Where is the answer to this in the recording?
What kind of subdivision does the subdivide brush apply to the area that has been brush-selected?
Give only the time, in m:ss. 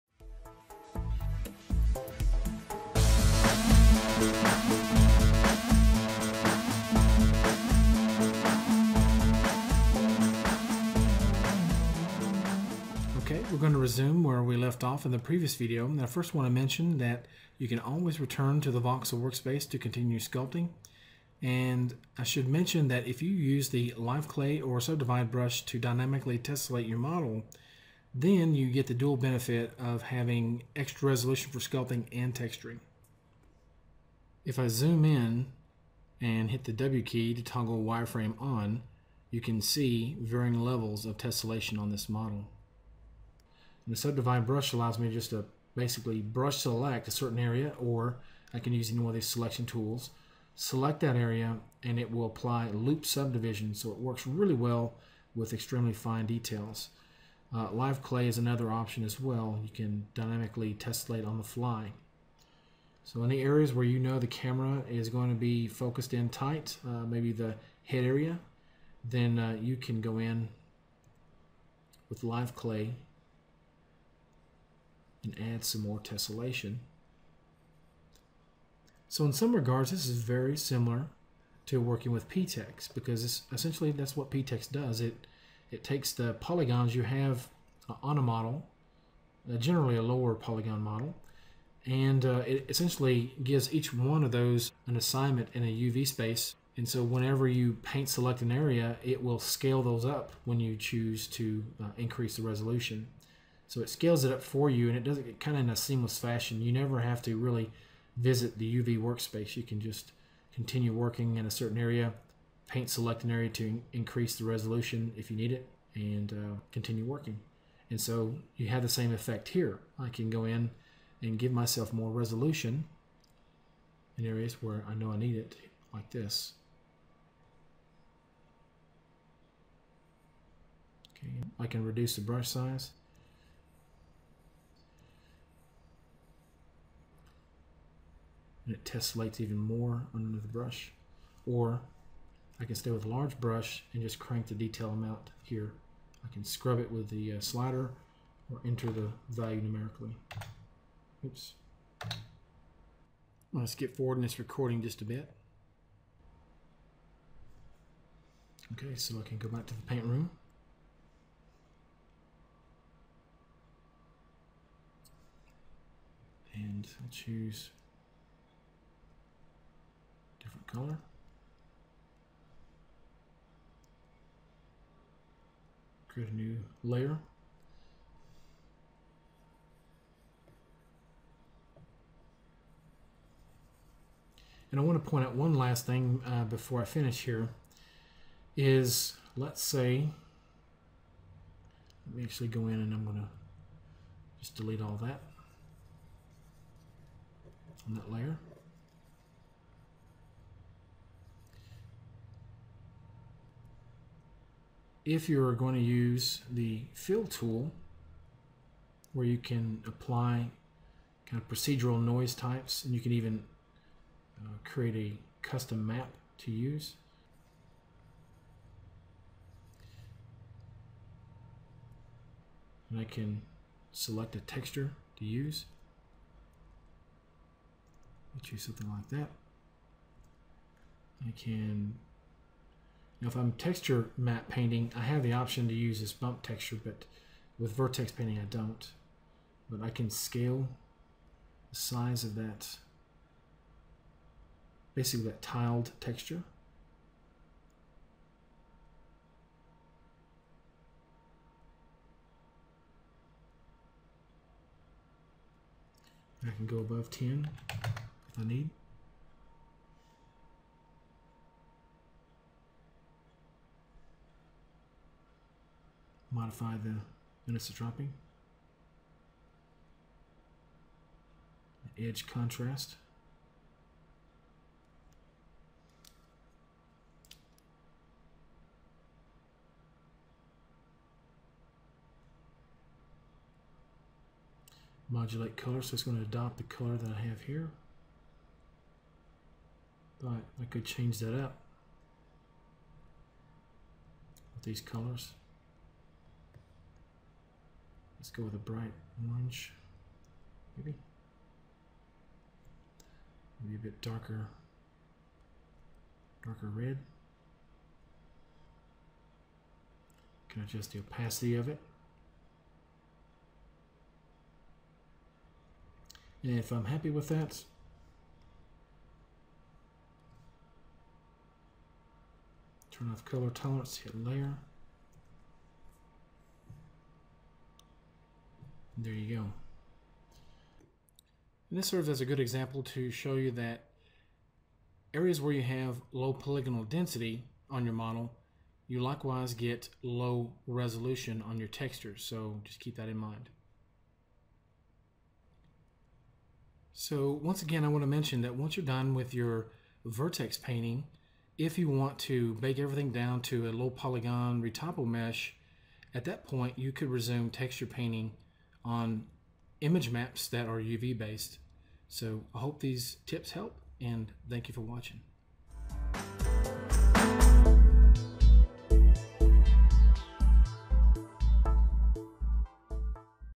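0:52.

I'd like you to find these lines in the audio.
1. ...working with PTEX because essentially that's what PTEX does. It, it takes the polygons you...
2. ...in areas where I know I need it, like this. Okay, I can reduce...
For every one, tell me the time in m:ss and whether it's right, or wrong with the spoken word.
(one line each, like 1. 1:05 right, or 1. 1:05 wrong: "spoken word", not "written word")
1. 1:21 right
2. 2:04 right.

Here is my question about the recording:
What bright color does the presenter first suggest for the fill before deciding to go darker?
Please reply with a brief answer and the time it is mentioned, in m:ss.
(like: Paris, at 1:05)
Orange, at 4:58.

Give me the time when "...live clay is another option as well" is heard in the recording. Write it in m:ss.
0:57.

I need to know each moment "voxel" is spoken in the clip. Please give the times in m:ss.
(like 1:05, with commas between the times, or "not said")
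0:18.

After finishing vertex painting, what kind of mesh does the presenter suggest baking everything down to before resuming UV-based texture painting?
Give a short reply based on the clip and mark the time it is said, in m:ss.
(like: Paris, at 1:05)
Low polygon retopo mesh, at 5:53.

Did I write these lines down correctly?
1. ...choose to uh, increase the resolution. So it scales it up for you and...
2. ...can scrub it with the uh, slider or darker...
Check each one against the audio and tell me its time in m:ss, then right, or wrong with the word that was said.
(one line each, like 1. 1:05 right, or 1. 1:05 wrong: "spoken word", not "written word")
1. 1:40 right
2. 2:26 wrong: "enter", not "darker".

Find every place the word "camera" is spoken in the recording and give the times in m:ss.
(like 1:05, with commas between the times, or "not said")
1:04.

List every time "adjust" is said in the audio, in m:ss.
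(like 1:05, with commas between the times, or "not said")
5:10.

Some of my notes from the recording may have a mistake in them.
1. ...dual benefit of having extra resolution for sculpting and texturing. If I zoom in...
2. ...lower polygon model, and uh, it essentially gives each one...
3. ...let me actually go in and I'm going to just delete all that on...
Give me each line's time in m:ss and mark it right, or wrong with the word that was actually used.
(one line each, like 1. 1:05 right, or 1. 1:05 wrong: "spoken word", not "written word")
1. 0:28 right
2. 1:30 right
3. 3:12 right.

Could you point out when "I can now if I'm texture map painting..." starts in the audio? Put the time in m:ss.
3:51.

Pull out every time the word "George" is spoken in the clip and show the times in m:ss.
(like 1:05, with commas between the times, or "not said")
not said.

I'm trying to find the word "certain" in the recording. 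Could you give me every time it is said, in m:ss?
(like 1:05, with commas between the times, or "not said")
0:47, 1:51.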